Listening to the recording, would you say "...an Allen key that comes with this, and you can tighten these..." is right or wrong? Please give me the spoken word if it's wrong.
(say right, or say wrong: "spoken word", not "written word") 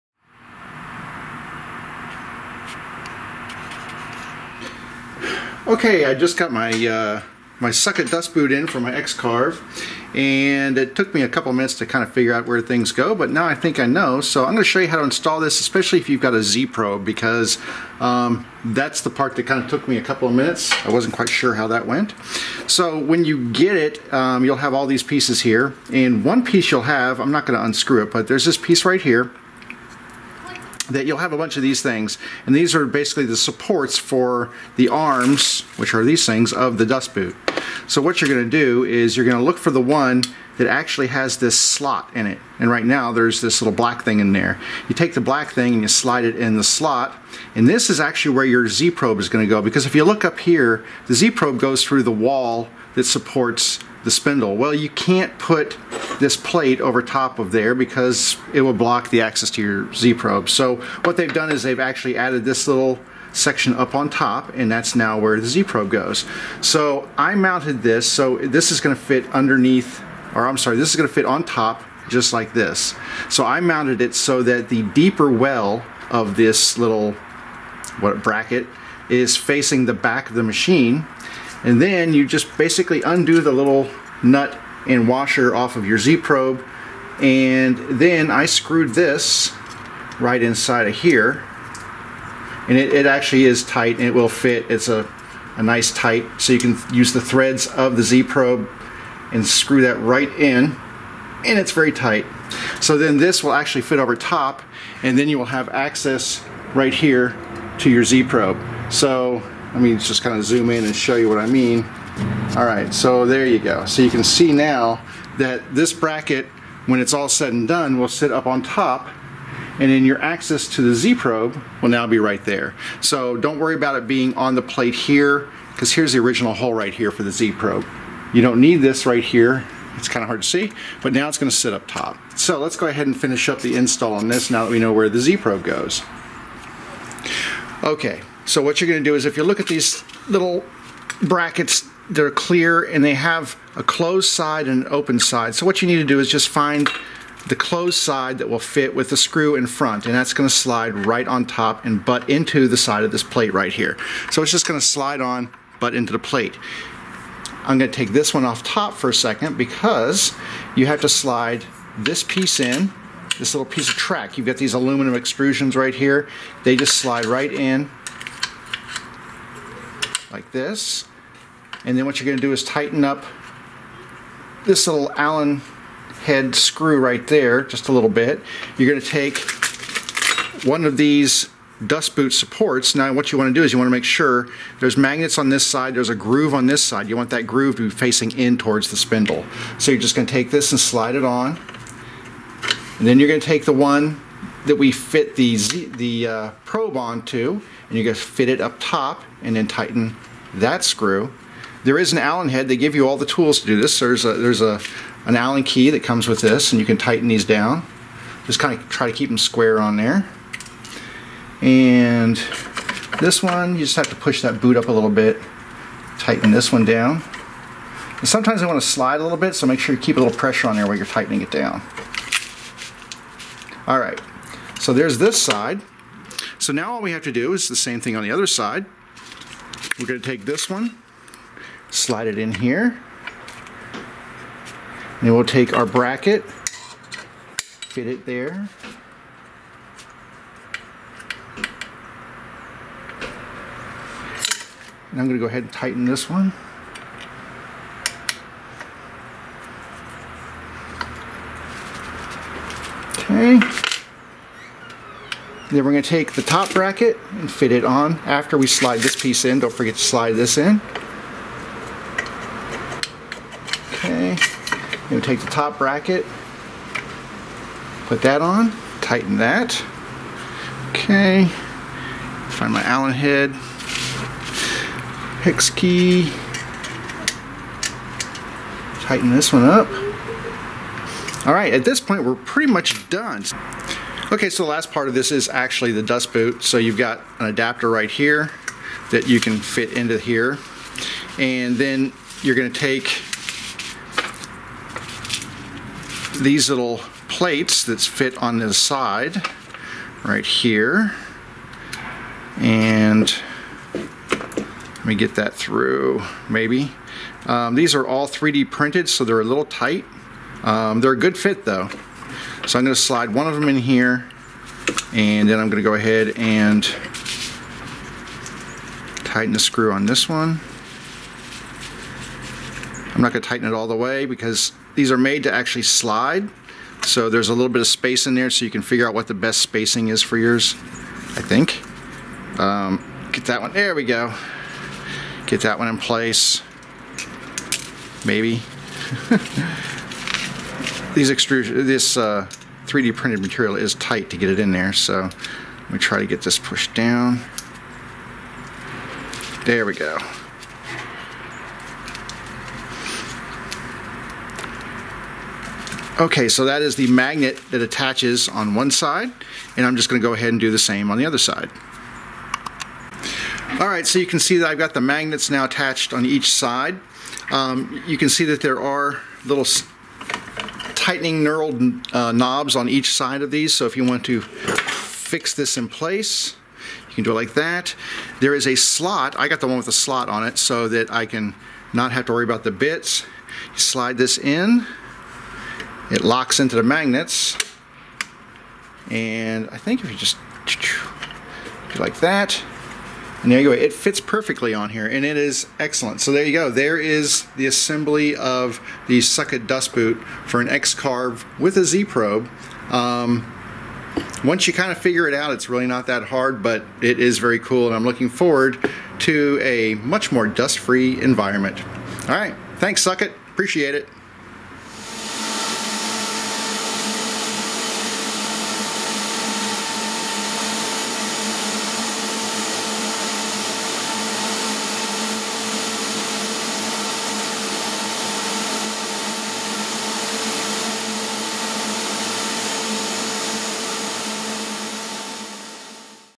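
right.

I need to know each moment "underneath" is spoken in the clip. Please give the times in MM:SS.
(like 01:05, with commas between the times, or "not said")
01:09.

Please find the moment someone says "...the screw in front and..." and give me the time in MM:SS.
02:29.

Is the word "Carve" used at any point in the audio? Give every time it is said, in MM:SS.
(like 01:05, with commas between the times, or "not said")
00:08, 06:40.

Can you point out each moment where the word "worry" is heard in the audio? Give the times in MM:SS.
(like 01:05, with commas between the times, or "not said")
02:03, 06:22.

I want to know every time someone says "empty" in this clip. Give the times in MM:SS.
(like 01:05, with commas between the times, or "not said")
not said.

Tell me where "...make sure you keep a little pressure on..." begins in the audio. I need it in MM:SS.
03:39.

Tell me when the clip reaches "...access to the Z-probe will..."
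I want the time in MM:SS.
02:00.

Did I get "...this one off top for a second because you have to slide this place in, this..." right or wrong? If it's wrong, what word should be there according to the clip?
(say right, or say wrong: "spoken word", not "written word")
wrong: "piece", not "place".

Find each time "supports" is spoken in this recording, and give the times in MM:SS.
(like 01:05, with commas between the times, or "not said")
00:33, 00:53, 03:02.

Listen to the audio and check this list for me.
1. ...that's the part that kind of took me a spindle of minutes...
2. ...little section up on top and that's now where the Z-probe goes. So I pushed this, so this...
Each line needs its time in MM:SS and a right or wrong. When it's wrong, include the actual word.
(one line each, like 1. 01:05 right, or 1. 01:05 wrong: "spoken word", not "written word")
1. 00:18 wrong: "couple", not "spindle"
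2. 01:02 wrong: "mounted", not "pushed".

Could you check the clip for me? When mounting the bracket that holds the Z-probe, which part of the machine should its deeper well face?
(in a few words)
the back.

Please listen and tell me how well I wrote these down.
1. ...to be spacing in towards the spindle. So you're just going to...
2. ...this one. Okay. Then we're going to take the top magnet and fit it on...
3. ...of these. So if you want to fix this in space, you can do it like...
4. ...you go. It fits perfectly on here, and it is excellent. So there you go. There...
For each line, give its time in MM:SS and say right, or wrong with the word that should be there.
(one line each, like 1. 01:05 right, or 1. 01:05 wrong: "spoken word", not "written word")
1. 03:07 wrong: "facing", not "spacing"
2. 04:06 wrong: "bracket", not "magnet"
3. 06:13 wrong: "place", not "space"
4. 06:33 right.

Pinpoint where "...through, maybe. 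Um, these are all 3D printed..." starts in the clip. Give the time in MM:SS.
05:05.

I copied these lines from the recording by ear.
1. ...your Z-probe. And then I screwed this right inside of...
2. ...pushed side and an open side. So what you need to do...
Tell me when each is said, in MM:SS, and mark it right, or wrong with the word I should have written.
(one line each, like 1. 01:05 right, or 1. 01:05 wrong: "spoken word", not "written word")
1. 01:25 right
2. 02:23 wrong: "closed", not "pushed".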